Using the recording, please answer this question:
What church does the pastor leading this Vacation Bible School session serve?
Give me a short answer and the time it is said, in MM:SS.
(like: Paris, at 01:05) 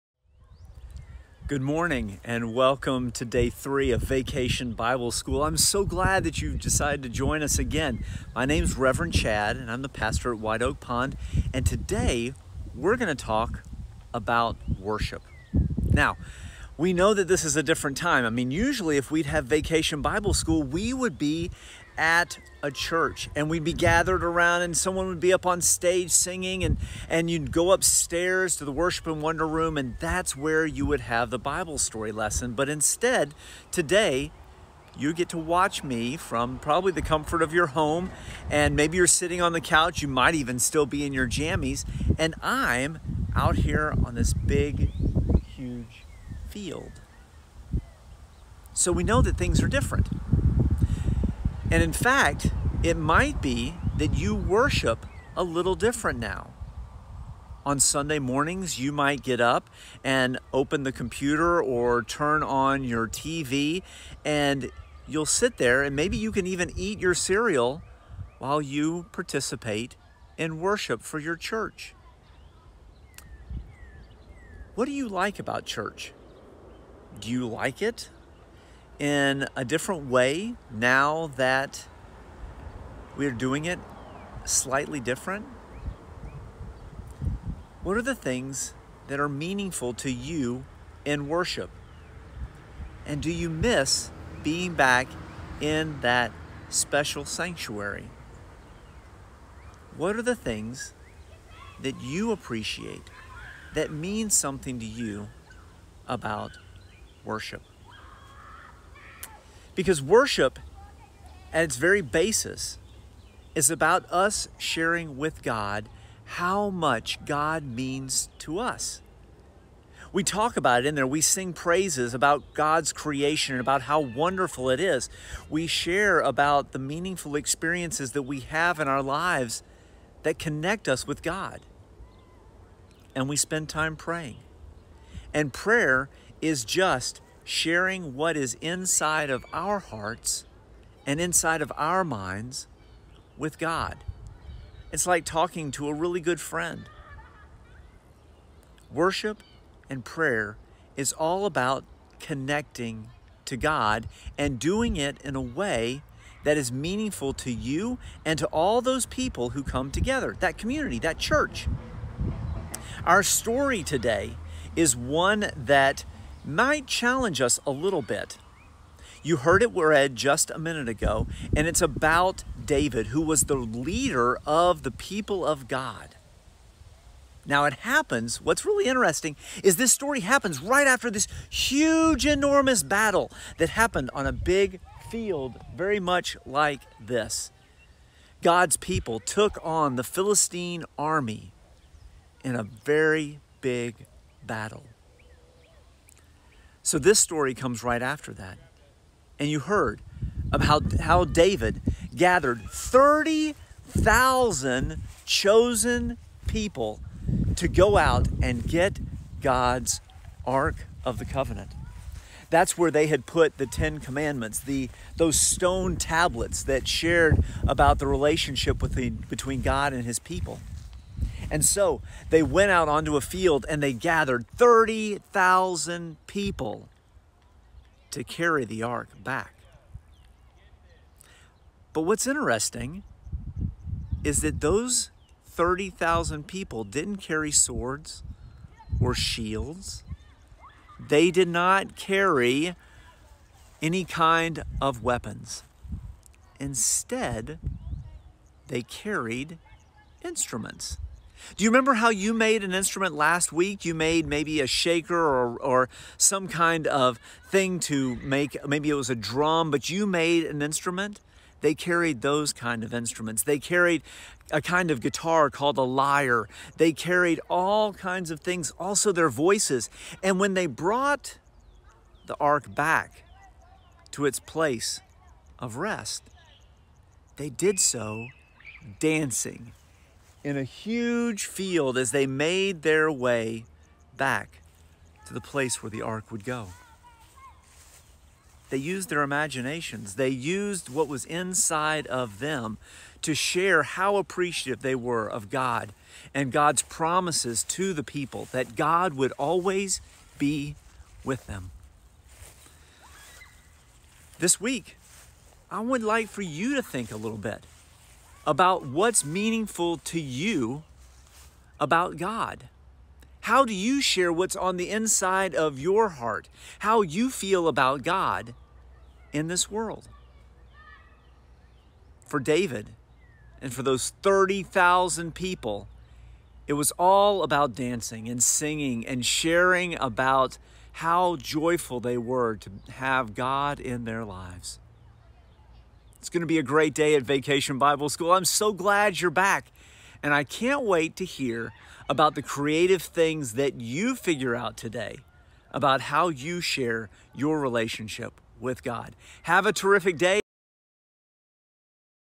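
White Oak Pond, at 00:10.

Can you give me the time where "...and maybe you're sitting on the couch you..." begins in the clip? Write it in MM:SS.
00:38.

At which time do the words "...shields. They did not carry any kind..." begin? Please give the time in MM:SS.
03:59.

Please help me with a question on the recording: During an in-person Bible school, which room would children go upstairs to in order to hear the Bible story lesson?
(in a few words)
worship and wonder room.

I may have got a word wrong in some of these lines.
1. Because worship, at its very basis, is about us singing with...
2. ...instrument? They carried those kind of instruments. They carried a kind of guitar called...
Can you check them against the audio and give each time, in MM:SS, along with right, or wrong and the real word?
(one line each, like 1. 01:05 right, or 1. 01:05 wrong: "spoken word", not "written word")
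1. 01:49 wrong: "sharing", not "singing"
2. 04:20 right.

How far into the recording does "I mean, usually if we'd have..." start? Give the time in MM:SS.
00:18.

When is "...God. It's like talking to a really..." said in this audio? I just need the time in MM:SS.
02:23.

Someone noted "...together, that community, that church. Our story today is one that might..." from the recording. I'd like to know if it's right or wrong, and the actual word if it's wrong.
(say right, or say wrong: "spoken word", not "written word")
right.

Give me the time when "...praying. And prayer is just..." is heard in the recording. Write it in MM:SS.
02:13.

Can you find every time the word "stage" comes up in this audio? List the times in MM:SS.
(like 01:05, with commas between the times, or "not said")
00:25.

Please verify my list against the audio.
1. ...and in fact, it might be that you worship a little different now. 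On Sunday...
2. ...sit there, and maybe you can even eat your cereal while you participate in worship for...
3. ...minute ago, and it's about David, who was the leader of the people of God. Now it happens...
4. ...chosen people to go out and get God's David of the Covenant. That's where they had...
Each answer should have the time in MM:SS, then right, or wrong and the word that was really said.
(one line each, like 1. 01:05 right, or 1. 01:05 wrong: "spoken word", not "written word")
1. 00:51 right
2. 01:05 right
3. 02:50 right
4. 03:25 wrong: "Ark", not "David".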